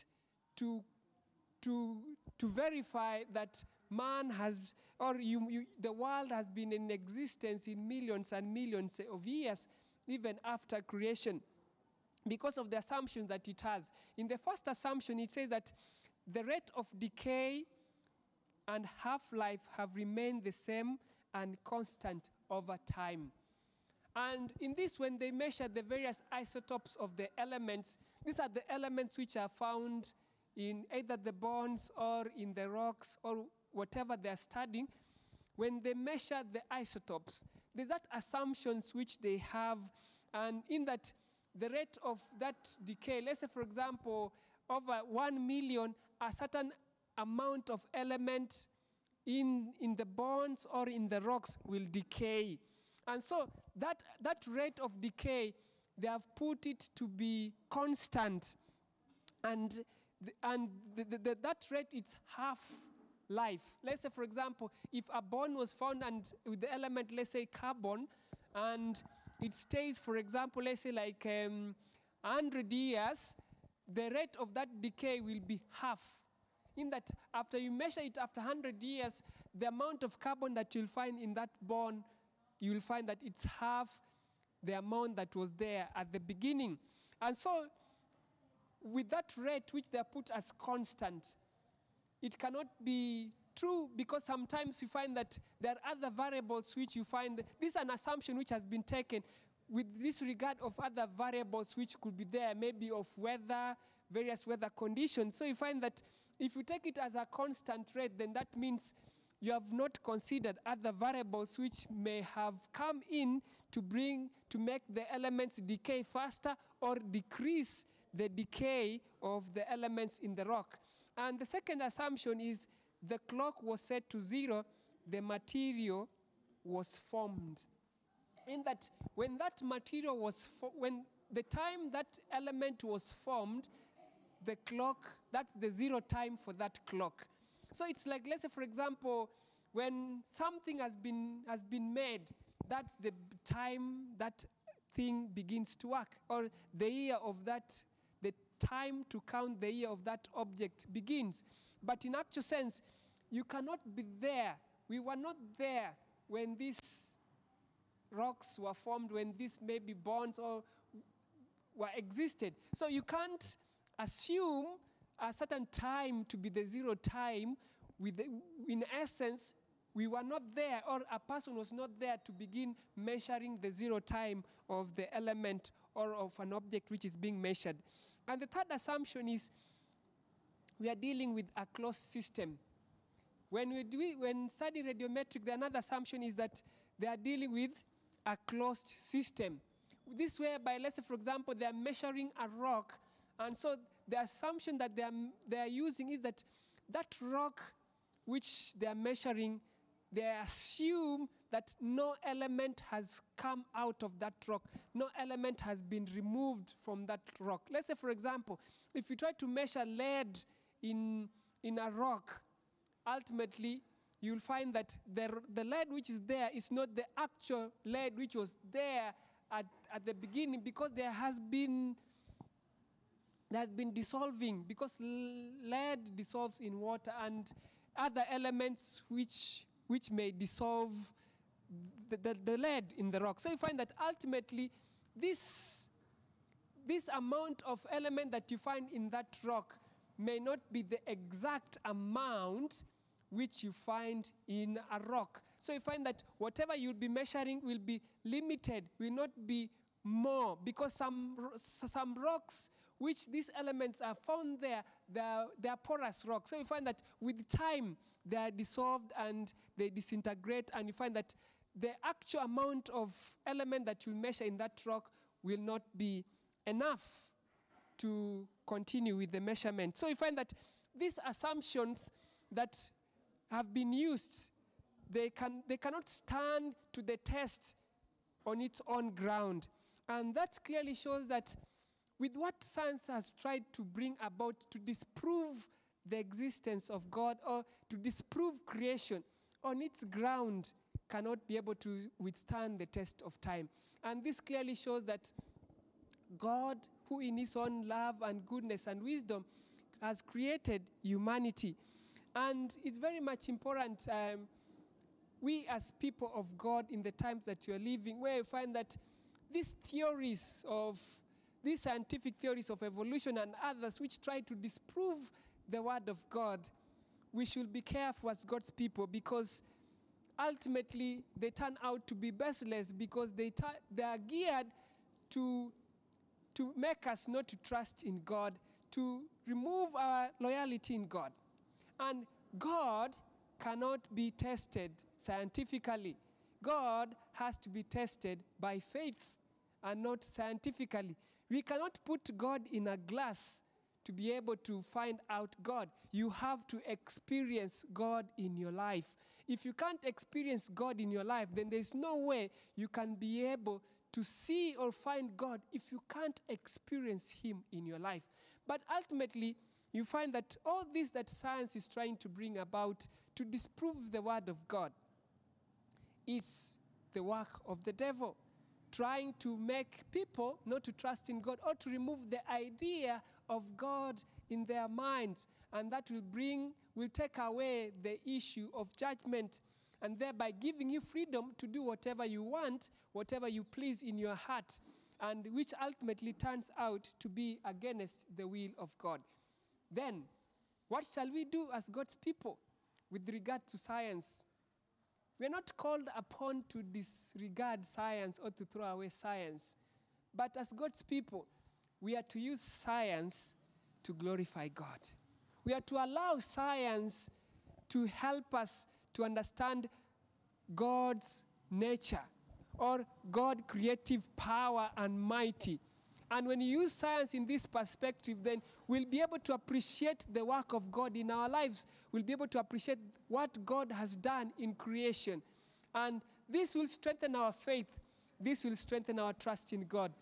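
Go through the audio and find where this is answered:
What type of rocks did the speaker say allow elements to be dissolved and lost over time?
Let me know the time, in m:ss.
4:15.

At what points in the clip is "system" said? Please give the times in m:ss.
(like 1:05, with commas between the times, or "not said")
3:01, 3:08.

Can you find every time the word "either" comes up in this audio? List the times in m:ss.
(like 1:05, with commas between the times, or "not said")
0:30.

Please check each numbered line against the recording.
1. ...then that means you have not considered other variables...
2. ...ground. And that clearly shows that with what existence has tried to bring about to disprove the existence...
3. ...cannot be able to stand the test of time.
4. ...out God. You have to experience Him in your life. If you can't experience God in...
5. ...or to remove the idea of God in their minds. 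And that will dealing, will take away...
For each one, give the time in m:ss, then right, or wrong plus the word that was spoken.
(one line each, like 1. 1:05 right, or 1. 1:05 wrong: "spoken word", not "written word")
1. 1:48 right
2. 4:39 wrong: "science", not "existence"
3. 4:51 wrong: "withstand", not "stand"
4. 5:45 wrong: "God", not "Him"
5. 6:11 wrong: "bring", not "dealing".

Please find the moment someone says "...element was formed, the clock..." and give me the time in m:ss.
2:12.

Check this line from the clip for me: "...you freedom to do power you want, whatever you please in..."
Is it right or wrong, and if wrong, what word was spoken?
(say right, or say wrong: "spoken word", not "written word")
wrong: "whatever", not "power".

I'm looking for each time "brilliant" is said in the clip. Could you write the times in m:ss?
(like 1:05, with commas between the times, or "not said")
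not said.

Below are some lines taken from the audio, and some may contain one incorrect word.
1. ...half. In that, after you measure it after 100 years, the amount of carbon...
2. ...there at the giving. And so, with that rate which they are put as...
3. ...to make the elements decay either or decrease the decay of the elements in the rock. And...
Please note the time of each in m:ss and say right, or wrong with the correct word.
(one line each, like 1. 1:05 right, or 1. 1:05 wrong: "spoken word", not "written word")
1. 1:15 right
2. 1:25 wrong: "beginning", not "giving"
3. 1:54 wrong: "faster", not "either".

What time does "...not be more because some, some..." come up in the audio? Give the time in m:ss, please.
4:09.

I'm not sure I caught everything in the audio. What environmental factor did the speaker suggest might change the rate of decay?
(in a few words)
weather conditions.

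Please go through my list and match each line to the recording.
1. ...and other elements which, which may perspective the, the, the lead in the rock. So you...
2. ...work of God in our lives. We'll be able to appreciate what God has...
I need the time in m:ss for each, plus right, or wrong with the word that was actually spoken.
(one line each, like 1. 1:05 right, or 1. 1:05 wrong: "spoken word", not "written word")
1. 3:47 wrong: "dissolve", not "perspective"
2. 7:00 right.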